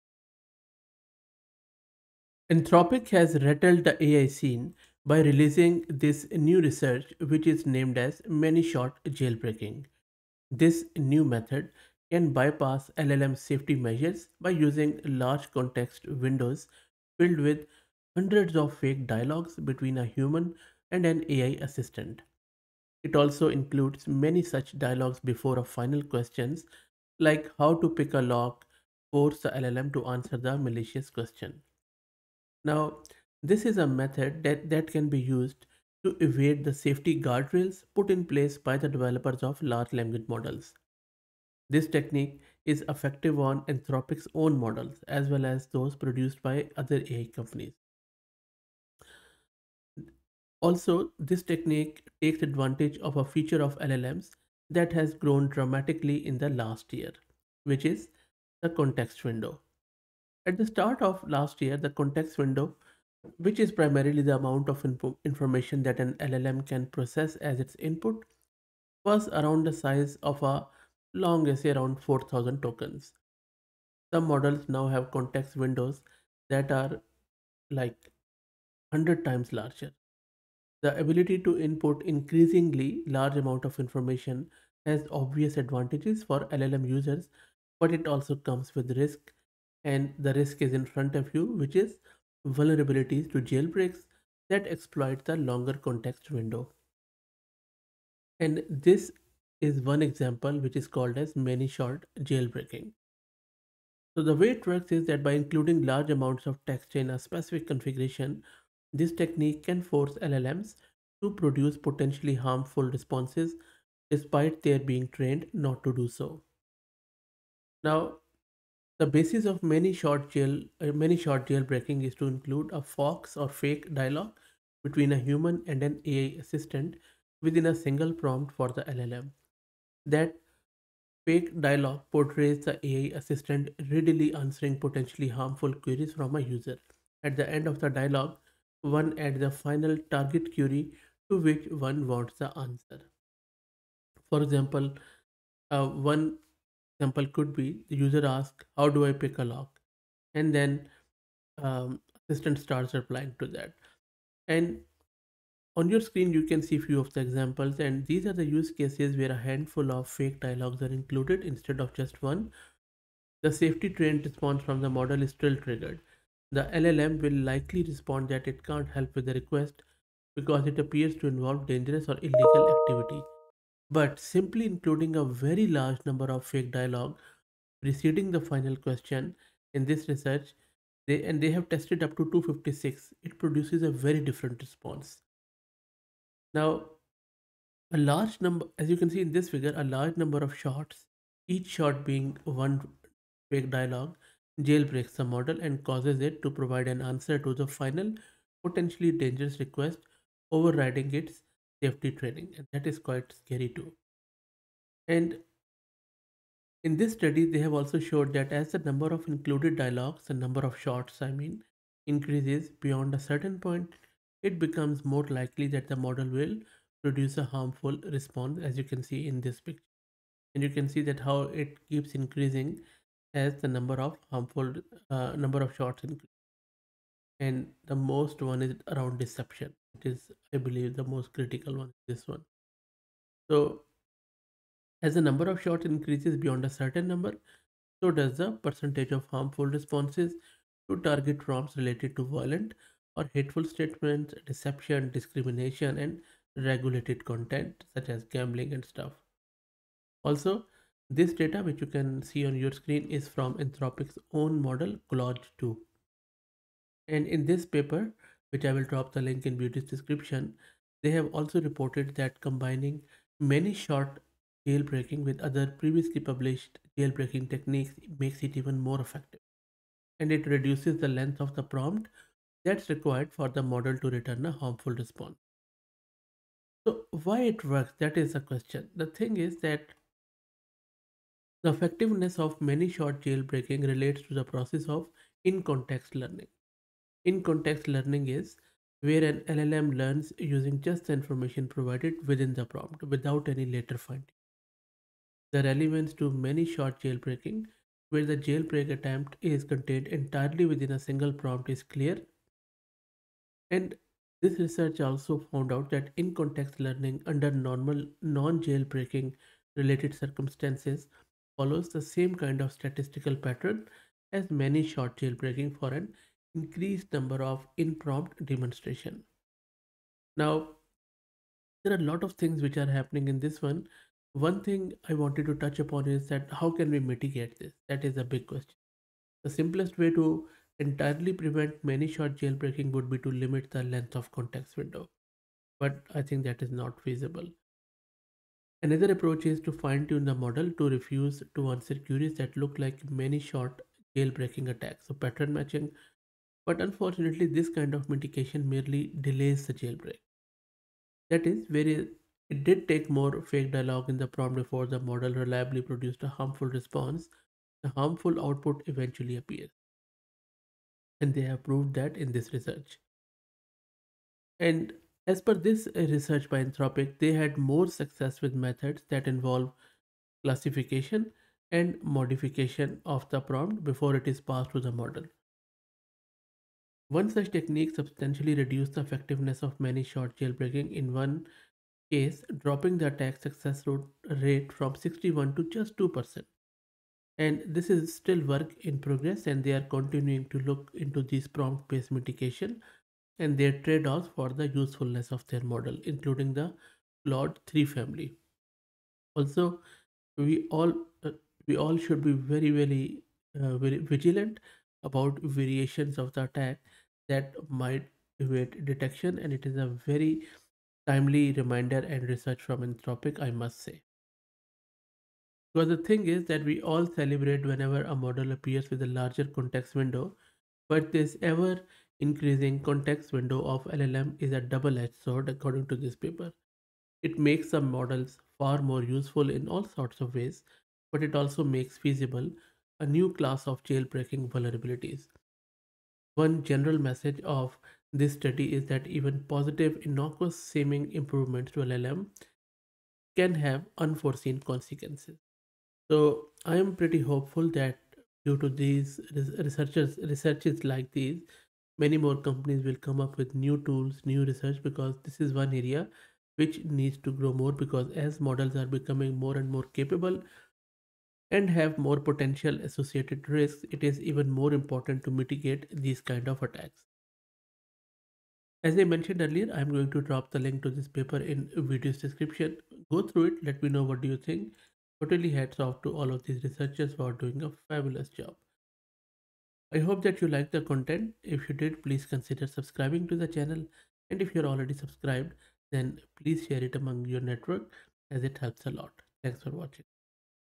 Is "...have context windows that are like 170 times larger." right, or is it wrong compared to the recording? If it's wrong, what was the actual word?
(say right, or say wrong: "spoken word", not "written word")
wrong: "100", not "170".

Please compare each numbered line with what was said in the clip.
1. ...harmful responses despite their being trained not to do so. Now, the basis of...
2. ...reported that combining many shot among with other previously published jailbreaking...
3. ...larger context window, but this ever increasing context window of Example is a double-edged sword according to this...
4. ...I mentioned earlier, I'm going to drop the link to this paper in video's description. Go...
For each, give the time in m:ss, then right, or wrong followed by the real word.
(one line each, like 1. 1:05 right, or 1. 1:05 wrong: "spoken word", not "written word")
1. 1:52 right
2. 4:21 wrong: "jailbreaking", not "among"
3. 6:59 wrong: "LLM", not "Example"
4. 7:48 right.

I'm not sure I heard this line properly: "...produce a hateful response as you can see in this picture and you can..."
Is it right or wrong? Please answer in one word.
wrong.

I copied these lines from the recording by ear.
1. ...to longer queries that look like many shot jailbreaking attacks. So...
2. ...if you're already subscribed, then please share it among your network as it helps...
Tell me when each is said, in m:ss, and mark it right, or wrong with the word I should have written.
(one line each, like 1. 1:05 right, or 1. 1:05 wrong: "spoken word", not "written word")
1. 5:41 wrong: "answer", not "longer"
2. 8:04 right.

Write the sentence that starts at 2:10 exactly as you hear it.
That fake dialogue portrays the AI assistant readily answering potentially harmful queries from a user.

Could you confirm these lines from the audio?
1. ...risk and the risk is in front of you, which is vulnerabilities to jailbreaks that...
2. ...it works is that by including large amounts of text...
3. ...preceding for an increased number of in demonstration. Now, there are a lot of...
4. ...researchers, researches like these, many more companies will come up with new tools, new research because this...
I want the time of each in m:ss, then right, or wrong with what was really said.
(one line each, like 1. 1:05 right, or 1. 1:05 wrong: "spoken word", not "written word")
1. 1:28 right
2. 1:44 right
3. 5:15 wrong: "jailbreaking", not "preceding"
4. 7:29 right.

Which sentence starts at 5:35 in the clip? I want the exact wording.
But I think that is not feasible.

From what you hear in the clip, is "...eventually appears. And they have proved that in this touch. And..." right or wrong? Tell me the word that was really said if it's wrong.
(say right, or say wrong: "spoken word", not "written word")
wrong: "research", not "touch".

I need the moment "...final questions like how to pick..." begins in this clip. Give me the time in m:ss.
0:25.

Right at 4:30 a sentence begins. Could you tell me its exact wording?
And it reduces the length of the prompt that's required for the model to return a harmful response.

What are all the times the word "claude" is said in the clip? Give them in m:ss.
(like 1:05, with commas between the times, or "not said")
4:15, 6:37.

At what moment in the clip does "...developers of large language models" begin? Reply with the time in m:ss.
0:38.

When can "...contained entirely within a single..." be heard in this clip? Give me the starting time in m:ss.
4:59.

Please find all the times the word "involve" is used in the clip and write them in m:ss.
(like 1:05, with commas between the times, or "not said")
2:51, 6:09.